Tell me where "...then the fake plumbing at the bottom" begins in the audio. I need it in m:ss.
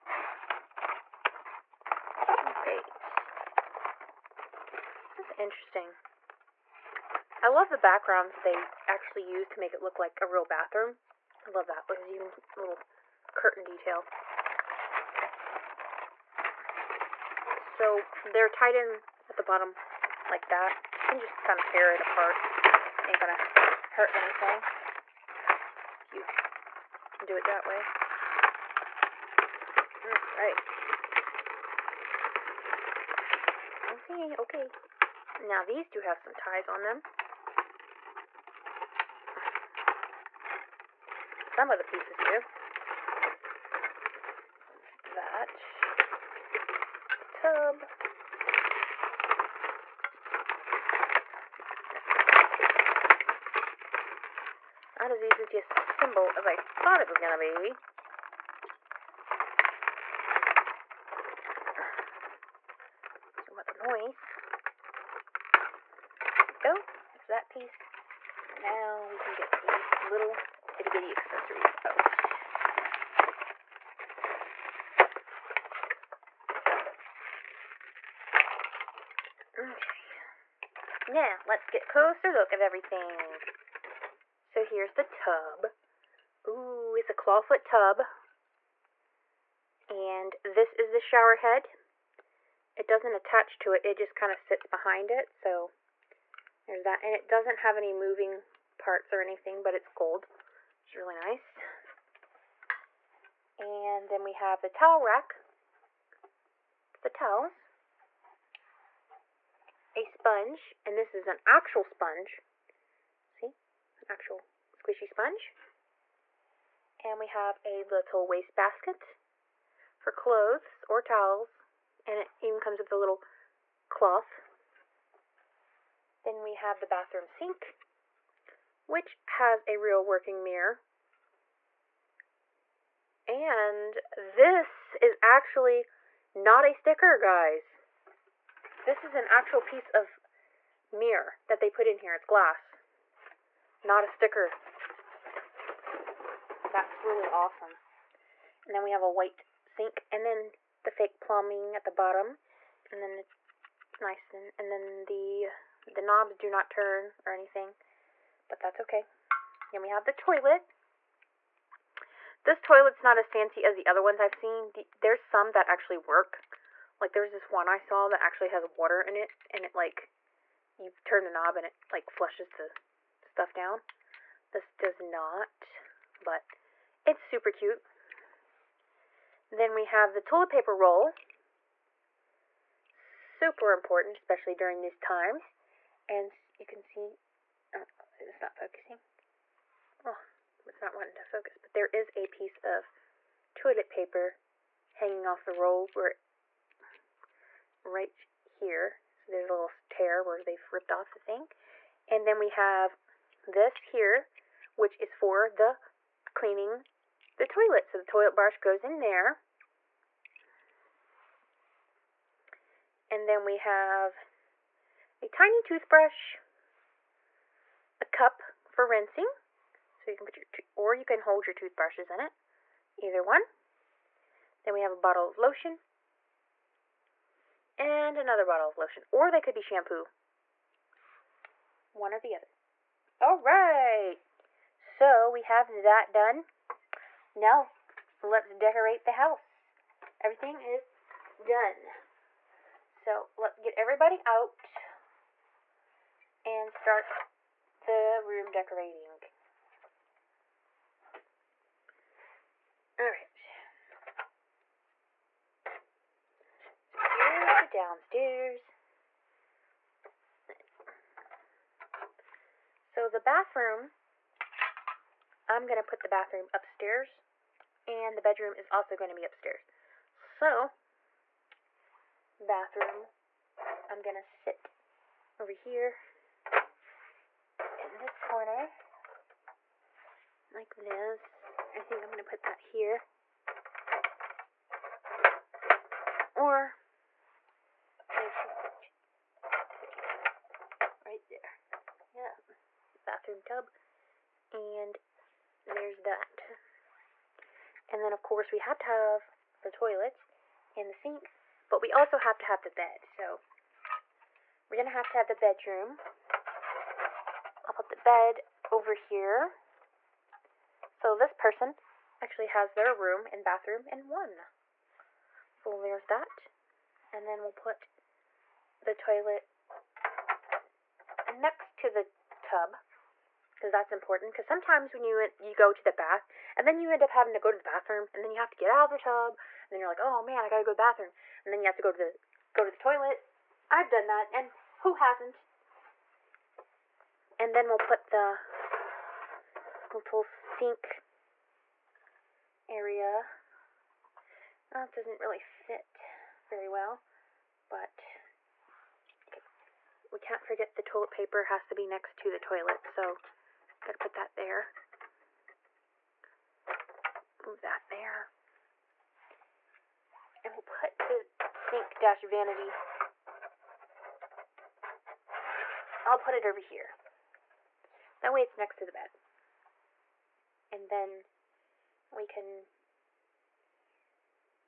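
2:30.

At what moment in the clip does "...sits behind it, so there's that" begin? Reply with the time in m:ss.
1:34.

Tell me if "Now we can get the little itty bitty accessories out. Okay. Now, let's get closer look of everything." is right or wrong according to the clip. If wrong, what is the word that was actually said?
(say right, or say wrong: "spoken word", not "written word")
right.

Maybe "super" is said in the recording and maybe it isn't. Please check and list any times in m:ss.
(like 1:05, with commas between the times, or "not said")
2:57, 3:02.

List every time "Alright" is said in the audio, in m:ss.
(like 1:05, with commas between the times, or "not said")
0:02, 4:12.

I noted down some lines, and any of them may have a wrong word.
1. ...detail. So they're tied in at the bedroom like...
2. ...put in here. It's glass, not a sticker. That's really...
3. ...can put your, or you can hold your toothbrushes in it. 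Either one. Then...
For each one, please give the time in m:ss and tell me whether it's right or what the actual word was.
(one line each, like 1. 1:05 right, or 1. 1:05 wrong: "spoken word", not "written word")
1. 0:13 wrong: "bottom", not "bedroom"
2. 2:21 right
3. 3:40 right.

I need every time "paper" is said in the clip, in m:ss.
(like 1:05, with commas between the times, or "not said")
3:00, 3:13, 5:51.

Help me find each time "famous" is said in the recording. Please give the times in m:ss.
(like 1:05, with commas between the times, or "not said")
not said.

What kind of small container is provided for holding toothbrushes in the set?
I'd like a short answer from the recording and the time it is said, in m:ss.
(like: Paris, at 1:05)
Toothbrush cup, at 3:35.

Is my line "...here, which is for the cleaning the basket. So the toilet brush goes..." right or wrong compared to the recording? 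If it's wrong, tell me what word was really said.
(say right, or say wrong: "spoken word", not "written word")
wrong: "toilet", not "basket".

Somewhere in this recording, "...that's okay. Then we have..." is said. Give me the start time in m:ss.
2:38.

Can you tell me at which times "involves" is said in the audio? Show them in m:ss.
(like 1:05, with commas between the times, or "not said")
not said.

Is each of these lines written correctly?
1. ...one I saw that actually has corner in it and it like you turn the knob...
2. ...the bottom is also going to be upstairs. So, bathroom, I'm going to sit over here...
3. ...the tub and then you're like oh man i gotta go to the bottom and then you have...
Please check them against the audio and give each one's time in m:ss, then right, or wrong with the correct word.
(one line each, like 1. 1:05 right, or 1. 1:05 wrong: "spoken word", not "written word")
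1. 2:47 wrong: "water", not "corner"
2. 4:28 wrong: "bedroom", not "bottom"
3. 5:28 wrong: "bathroom", not "bottom".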